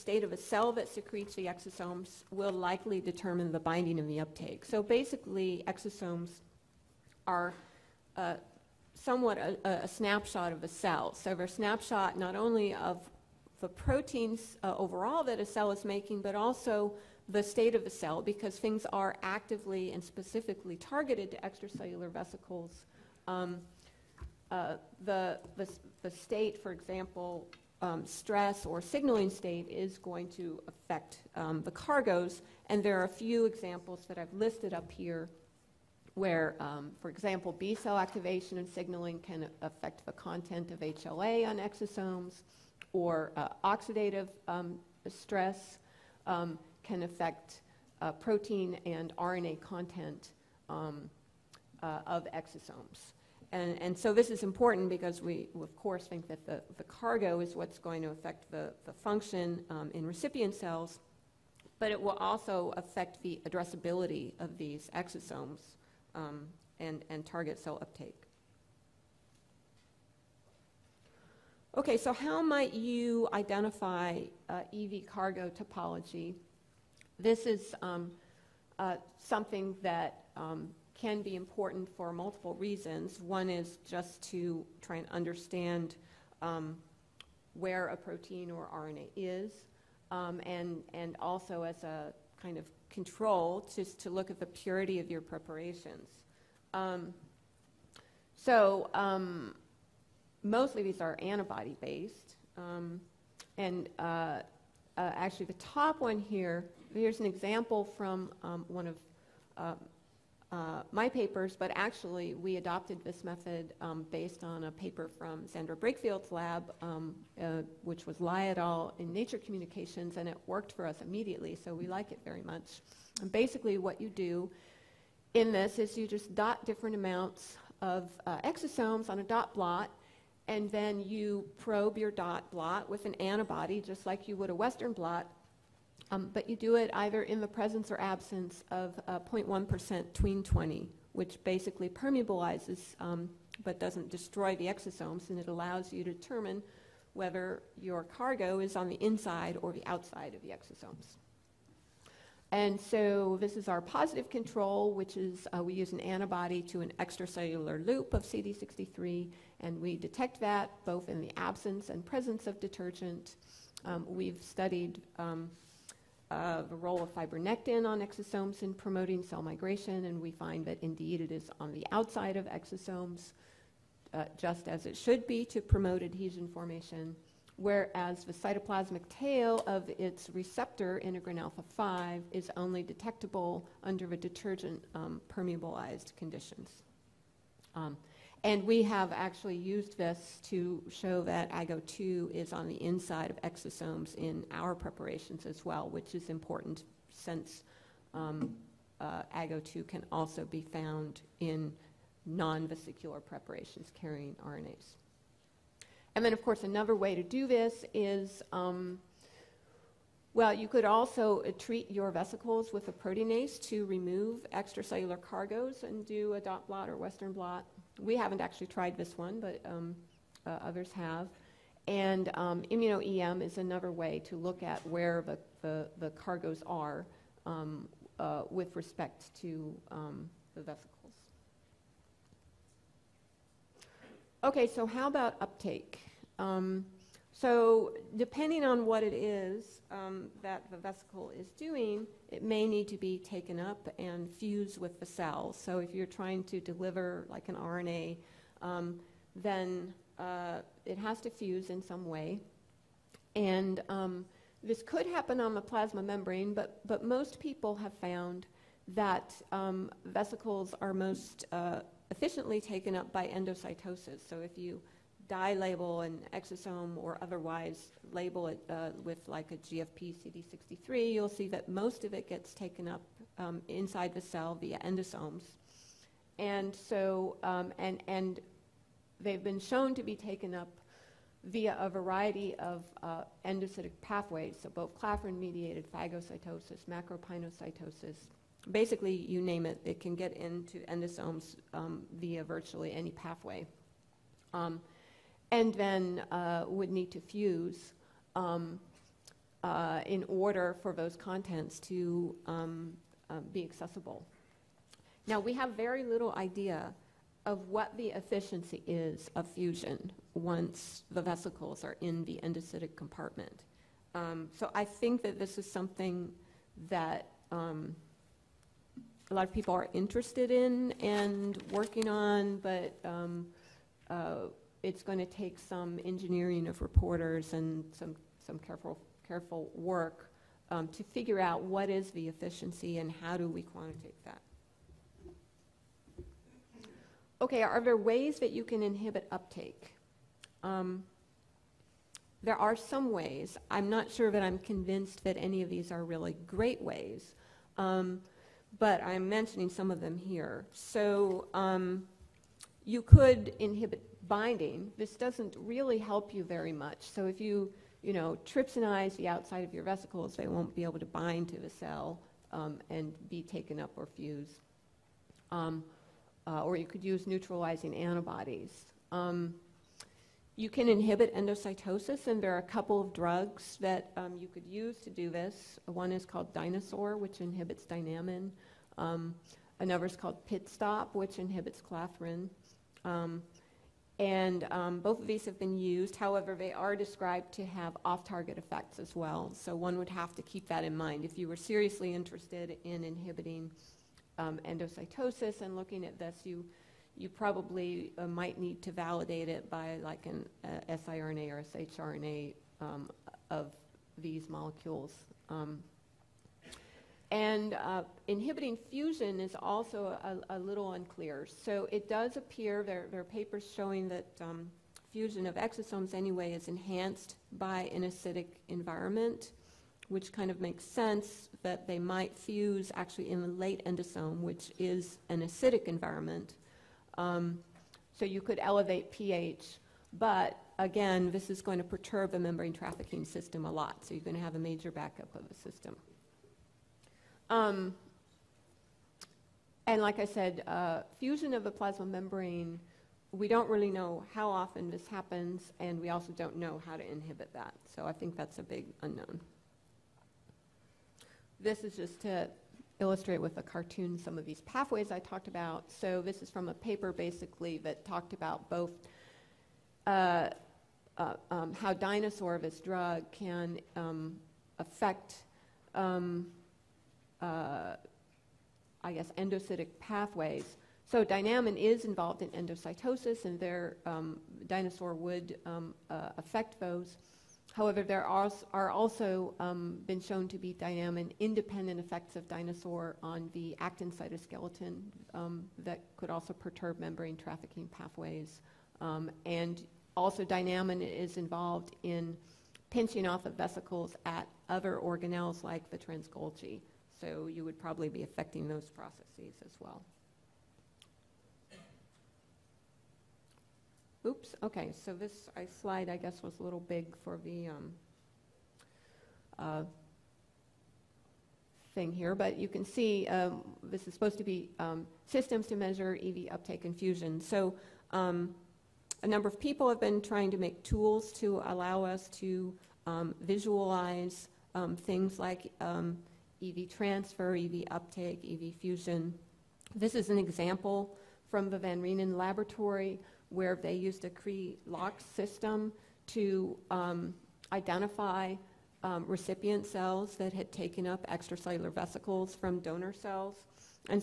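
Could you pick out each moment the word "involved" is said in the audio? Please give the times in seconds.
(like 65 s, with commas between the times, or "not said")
472 s, 491 s.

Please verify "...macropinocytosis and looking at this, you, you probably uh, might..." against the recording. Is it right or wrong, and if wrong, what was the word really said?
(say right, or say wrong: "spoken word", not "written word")
wrong: "endocytosis", not "macropinocytosis".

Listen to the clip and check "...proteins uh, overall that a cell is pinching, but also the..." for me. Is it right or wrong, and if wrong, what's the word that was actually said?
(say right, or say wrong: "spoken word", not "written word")
wrong: "making", not "pinching".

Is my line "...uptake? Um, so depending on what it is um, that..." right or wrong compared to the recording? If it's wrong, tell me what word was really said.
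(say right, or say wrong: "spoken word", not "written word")
right.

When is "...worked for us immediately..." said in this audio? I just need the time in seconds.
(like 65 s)
120 s.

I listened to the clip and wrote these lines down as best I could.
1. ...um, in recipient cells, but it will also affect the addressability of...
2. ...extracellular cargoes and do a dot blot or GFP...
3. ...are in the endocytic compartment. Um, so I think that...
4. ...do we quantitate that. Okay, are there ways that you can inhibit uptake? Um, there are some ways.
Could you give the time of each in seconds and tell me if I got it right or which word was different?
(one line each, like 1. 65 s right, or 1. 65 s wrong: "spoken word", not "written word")
1. 59 s right
2. 214 s wrong: "Western", not "GFP"
3. 311 s right
4. 333 s right.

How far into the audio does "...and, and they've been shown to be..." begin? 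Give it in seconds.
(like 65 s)
277 s.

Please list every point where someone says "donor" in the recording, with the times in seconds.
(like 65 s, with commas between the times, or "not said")
542 s.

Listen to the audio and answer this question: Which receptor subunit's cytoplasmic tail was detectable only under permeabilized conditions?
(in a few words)
integrin alpha 5.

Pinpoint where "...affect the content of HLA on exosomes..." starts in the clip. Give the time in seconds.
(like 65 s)
39 s.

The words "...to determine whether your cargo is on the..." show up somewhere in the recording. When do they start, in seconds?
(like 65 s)
146 s.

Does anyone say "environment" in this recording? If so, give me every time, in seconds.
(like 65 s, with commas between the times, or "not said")
418 s, 425 s.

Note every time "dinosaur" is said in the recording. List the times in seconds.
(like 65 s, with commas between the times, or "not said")
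376 s, 461 s, 474 s, 482 s.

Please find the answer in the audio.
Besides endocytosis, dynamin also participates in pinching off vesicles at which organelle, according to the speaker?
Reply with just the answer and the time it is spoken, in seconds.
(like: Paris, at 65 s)
trans-Golgi, at 495 s.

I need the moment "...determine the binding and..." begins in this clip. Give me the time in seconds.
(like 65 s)
3 s.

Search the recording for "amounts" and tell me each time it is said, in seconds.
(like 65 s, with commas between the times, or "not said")
126 s.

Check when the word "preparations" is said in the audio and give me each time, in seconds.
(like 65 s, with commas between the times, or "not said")
95 s, 194 s, 203 s.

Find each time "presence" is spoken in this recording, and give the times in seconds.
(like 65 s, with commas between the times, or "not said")
137 s, 162 s.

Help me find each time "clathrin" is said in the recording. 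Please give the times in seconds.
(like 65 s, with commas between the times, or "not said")
284 s, 381 s.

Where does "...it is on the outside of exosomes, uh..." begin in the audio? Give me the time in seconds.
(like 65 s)
171 s.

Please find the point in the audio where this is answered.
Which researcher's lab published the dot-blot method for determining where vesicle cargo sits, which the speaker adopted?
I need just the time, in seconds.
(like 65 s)
115 s.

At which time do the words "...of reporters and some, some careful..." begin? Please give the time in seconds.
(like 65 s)
326 s.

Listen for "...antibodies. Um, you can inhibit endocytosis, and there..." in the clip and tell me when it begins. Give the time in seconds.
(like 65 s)
367 s.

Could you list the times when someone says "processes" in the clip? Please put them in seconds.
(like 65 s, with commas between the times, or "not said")
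498 s.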